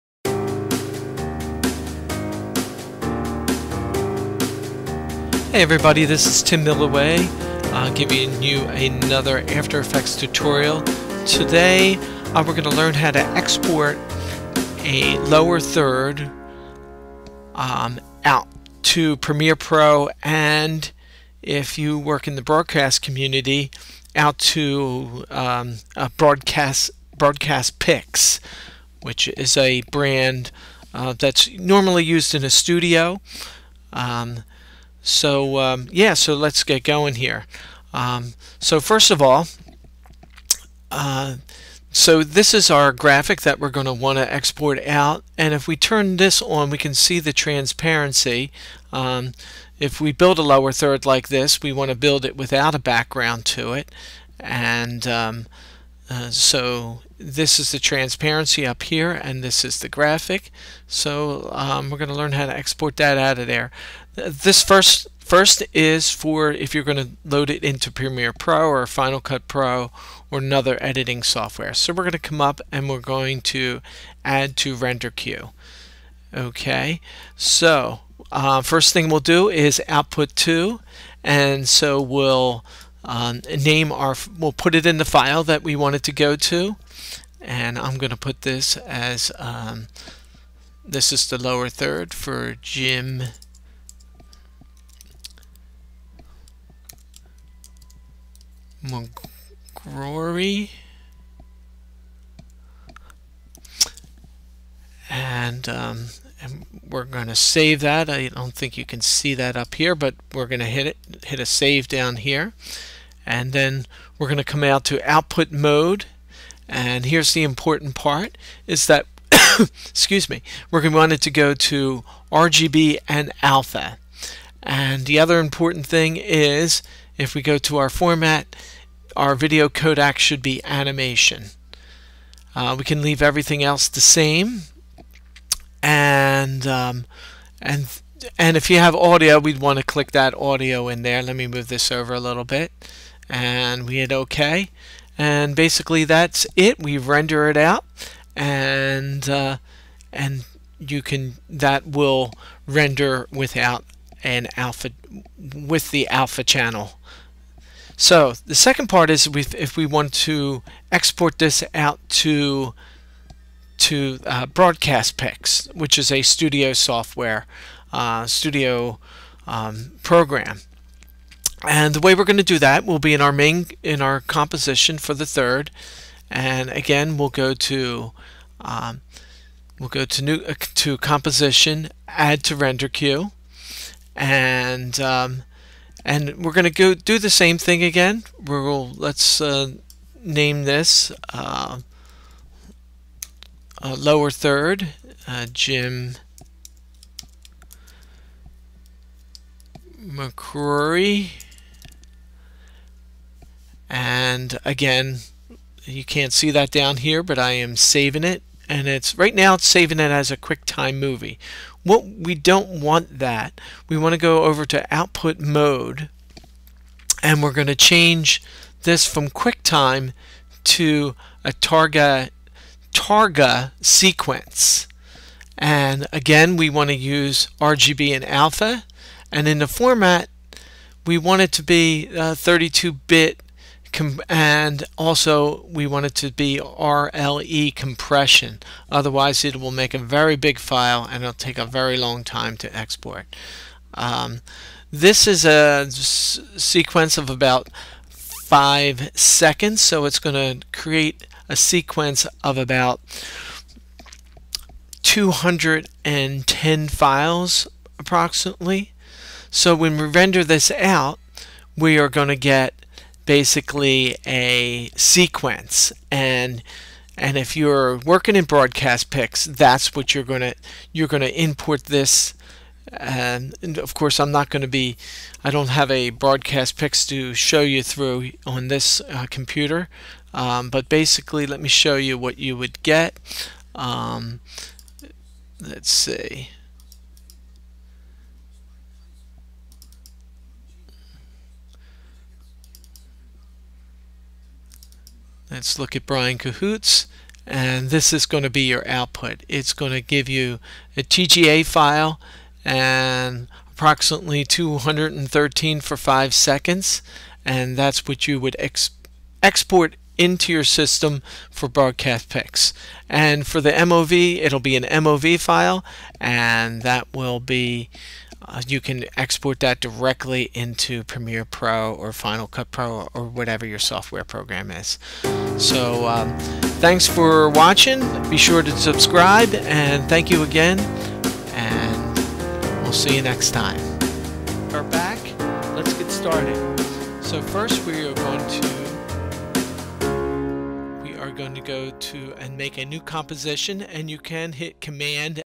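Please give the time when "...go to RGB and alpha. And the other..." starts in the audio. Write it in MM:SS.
02:01.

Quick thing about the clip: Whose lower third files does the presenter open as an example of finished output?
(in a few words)
Brian Cahoots.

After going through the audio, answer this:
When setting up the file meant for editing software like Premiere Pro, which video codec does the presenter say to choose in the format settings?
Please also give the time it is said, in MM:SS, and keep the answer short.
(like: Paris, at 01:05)
Animation, at 02:10.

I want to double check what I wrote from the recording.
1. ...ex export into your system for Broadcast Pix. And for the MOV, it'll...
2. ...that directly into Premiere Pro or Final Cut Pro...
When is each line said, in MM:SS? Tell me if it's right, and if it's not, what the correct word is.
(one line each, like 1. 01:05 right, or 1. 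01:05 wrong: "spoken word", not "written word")
1. 05:08 right
2. 05:19 right.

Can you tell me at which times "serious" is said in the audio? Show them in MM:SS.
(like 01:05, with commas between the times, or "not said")
not said.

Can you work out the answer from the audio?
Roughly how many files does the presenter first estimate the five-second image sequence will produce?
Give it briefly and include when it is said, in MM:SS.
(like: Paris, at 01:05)
210, at 04:15.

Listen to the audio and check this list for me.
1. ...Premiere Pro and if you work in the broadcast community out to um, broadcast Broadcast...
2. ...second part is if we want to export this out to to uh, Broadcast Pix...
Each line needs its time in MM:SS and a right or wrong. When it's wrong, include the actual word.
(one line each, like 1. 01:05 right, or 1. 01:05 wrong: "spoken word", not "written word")
1. 00:19 right
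2. 02:38 right.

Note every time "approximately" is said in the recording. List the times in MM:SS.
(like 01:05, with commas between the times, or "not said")
04:17, 05:03.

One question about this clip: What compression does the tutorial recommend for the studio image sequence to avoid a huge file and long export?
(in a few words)
RLE.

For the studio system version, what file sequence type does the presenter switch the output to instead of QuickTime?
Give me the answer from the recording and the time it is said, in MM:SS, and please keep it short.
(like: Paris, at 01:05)
Targa sequence, at 03:41.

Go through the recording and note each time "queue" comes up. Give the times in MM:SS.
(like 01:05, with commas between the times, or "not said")
01:15, 03:02.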